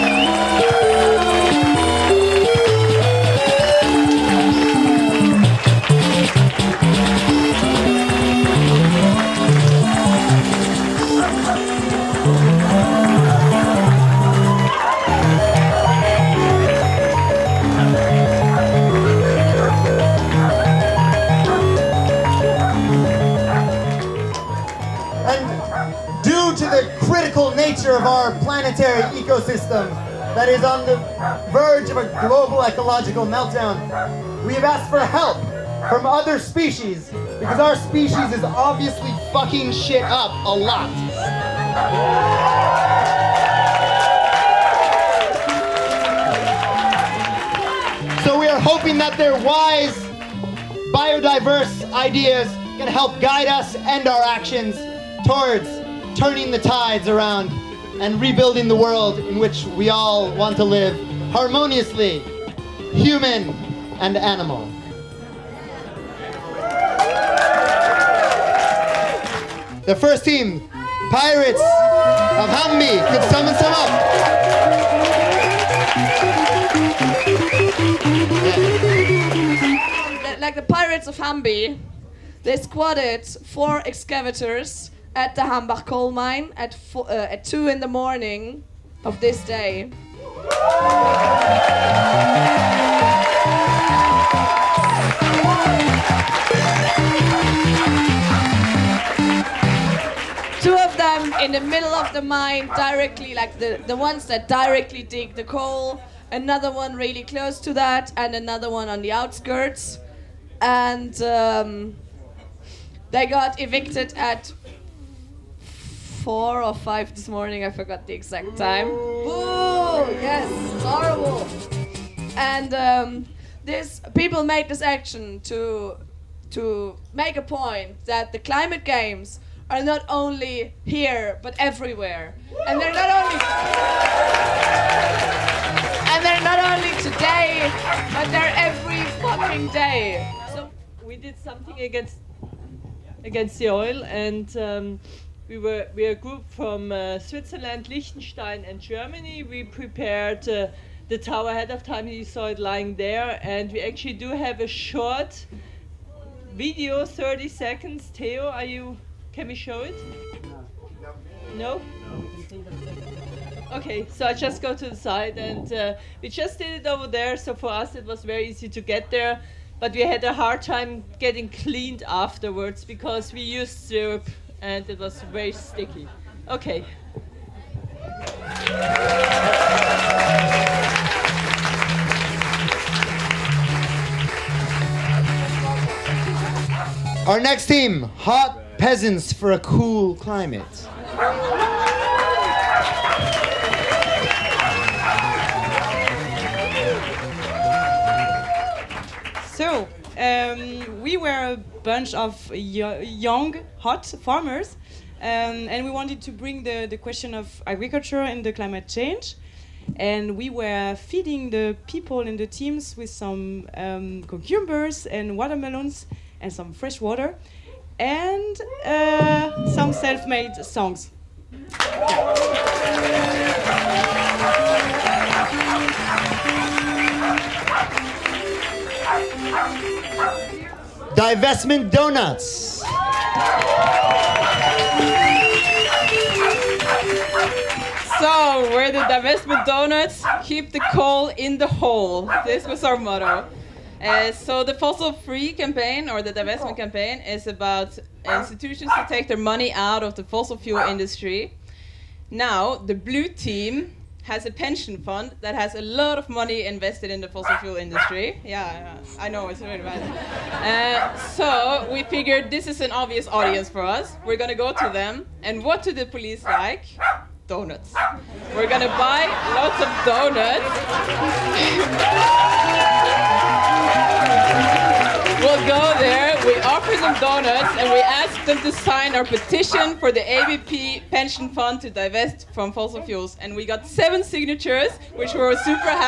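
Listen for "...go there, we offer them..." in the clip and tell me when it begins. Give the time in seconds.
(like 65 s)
275 s.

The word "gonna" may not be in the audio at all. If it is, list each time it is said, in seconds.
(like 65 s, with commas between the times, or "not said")
264 s, 268 s.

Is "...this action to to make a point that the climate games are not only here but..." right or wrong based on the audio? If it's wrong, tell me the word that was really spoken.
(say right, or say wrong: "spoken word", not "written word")
right.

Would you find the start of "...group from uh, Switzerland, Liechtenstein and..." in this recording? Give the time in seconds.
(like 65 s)
146 s.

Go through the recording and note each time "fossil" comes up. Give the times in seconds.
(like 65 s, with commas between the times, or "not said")
244 s, 250 s, 257 s, 282 s.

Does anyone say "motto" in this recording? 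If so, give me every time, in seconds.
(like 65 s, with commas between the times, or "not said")
242 s.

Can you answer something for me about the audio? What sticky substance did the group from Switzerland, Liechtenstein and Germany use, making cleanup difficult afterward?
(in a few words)
syrup.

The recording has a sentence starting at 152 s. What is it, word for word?
You saw it lying there and we actually do have a short video 30 seconds.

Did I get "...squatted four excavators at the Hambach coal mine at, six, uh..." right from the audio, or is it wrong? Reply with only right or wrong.
wrong.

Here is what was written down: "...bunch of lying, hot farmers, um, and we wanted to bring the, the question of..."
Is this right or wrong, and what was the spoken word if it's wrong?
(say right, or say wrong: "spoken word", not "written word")
wrong: "young", not "lying".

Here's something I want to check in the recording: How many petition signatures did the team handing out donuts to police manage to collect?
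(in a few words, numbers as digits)
7.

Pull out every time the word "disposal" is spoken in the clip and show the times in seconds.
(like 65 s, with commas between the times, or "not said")
not said.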